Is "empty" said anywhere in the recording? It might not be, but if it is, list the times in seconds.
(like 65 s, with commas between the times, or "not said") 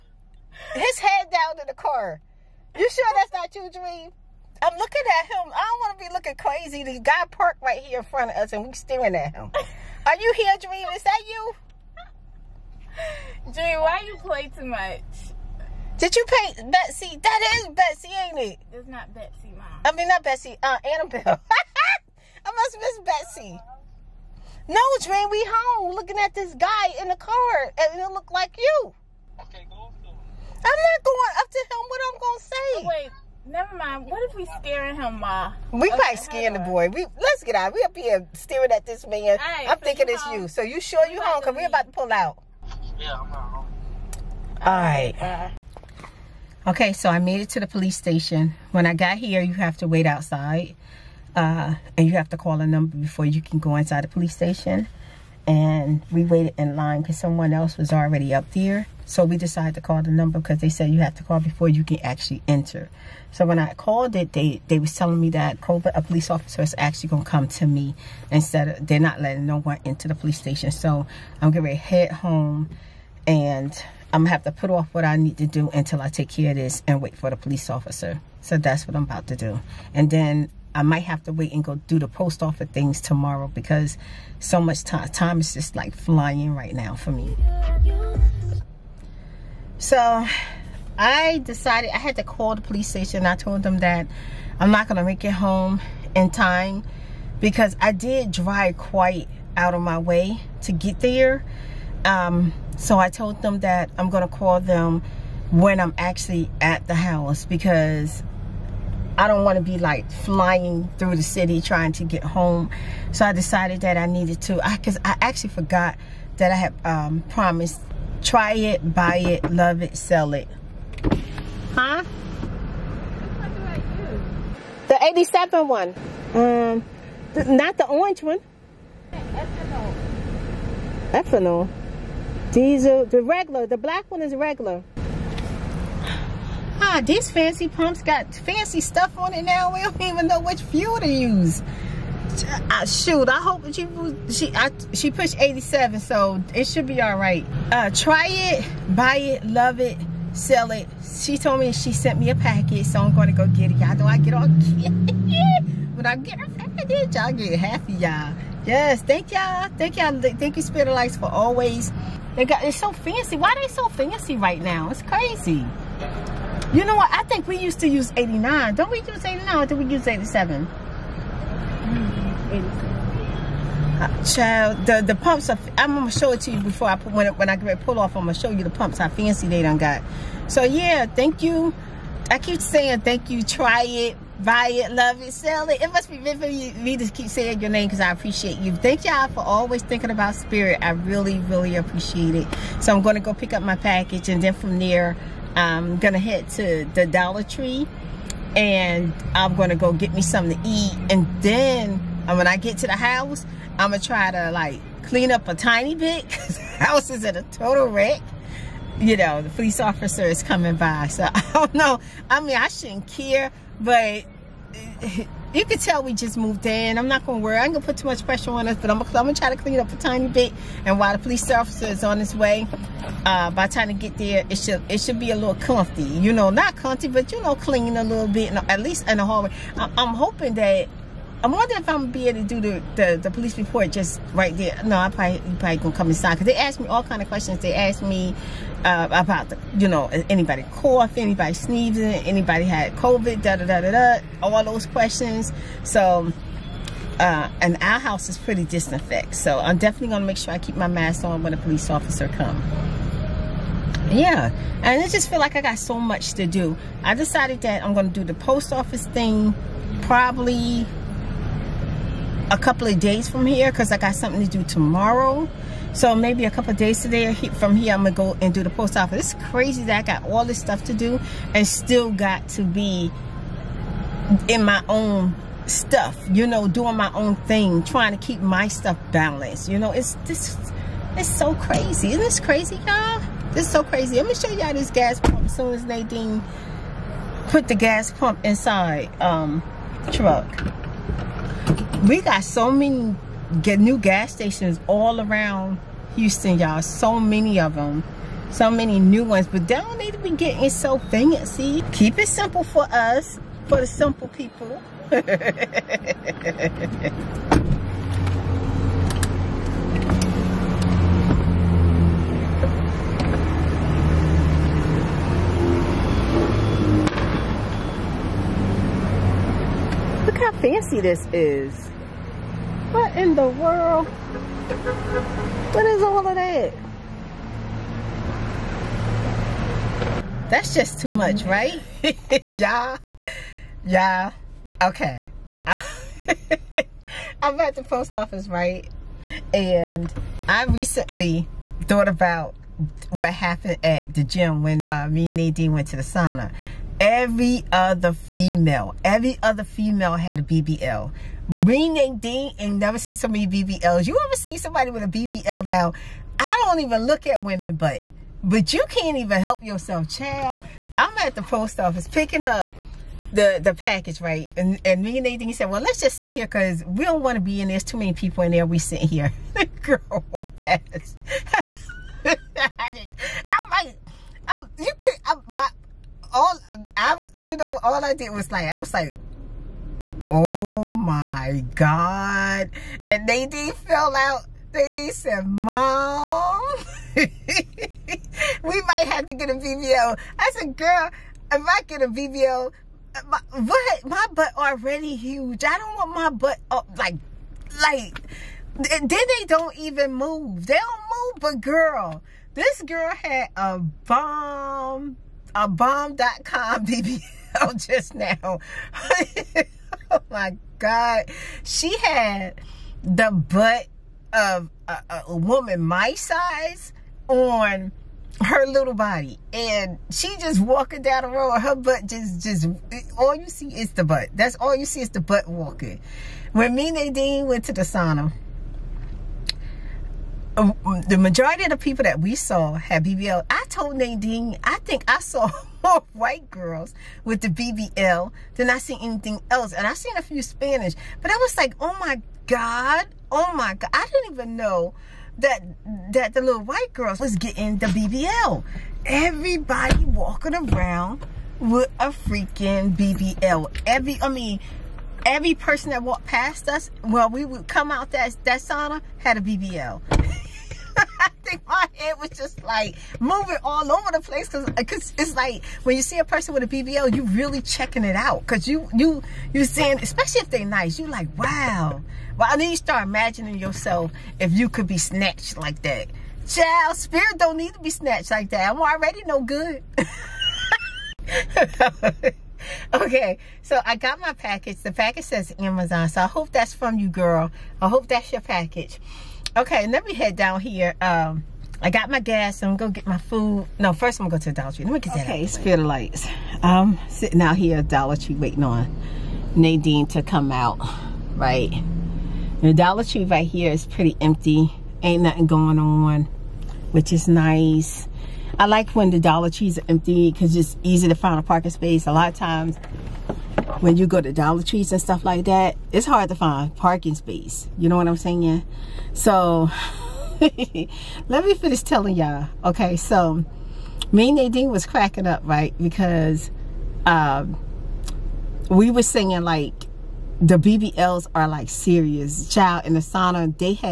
504 s, 509 s.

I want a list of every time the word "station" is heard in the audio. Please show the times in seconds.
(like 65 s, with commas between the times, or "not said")
47 s, 54 s, 70 s, 92 s, 294 s.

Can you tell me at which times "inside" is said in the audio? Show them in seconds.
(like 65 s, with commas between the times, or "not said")
53 s, 236 s, 288 s.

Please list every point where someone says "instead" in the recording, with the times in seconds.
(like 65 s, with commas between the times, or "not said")
68 s.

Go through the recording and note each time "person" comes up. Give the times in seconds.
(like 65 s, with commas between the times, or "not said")
455 s, 466 s.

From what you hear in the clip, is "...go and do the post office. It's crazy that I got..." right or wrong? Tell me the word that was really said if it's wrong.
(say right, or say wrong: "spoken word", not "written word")
right.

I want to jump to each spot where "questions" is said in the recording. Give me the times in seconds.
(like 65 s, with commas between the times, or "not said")
237 s, 244 s.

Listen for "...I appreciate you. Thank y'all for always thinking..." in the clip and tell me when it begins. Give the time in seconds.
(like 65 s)
187 s.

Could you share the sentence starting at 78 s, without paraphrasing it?
So that's what I'm about to do.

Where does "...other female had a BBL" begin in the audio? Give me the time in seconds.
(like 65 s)
349 s.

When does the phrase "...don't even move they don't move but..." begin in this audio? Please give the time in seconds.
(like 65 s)
399 s.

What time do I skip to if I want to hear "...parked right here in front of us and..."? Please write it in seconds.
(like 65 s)
7 s.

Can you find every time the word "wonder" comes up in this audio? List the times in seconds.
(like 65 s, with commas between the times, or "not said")
231 s.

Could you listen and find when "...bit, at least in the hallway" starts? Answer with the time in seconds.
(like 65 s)
228 s.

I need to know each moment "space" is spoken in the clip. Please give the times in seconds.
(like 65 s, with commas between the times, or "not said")
511 s, 517 s.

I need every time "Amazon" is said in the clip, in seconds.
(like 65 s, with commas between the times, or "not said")
485 s.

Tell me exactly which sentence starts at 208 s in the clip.
You know, the police officer is coming by.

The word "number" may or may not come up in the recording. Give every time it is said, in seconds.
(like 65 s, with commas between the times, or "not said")
52 s, 60 s.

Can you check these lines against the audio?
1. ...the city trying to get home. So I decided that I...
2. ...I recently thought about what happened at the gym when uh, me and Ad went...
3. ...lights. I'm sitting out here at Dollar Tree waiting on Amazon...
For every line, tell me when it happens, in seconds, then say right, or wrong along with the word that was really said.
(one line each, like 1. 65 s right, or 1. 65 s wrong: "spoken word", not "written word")
1. 111 s right
2. 340 s right
3. 495 s wrong: "Nadine", not "Amazon".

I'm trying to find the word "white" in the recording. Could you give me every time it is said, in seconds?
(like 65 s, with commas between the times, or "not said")
436 s, 446 s.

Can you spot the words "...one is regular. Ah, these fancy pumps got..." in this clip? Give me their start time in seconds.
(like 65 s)
134 s.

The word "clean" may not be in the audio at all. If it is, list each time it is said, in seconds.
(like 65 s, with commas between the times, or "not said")
205 s, 219 s, 227 s.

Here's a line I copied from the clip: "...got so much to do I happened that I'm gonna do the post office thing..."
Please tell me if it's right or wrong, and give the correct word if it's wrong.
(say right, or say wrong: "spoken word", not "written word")
wrong: "decided", not "happened".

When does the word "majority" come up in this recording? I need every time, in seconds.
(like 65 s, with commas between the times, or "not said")
431 s.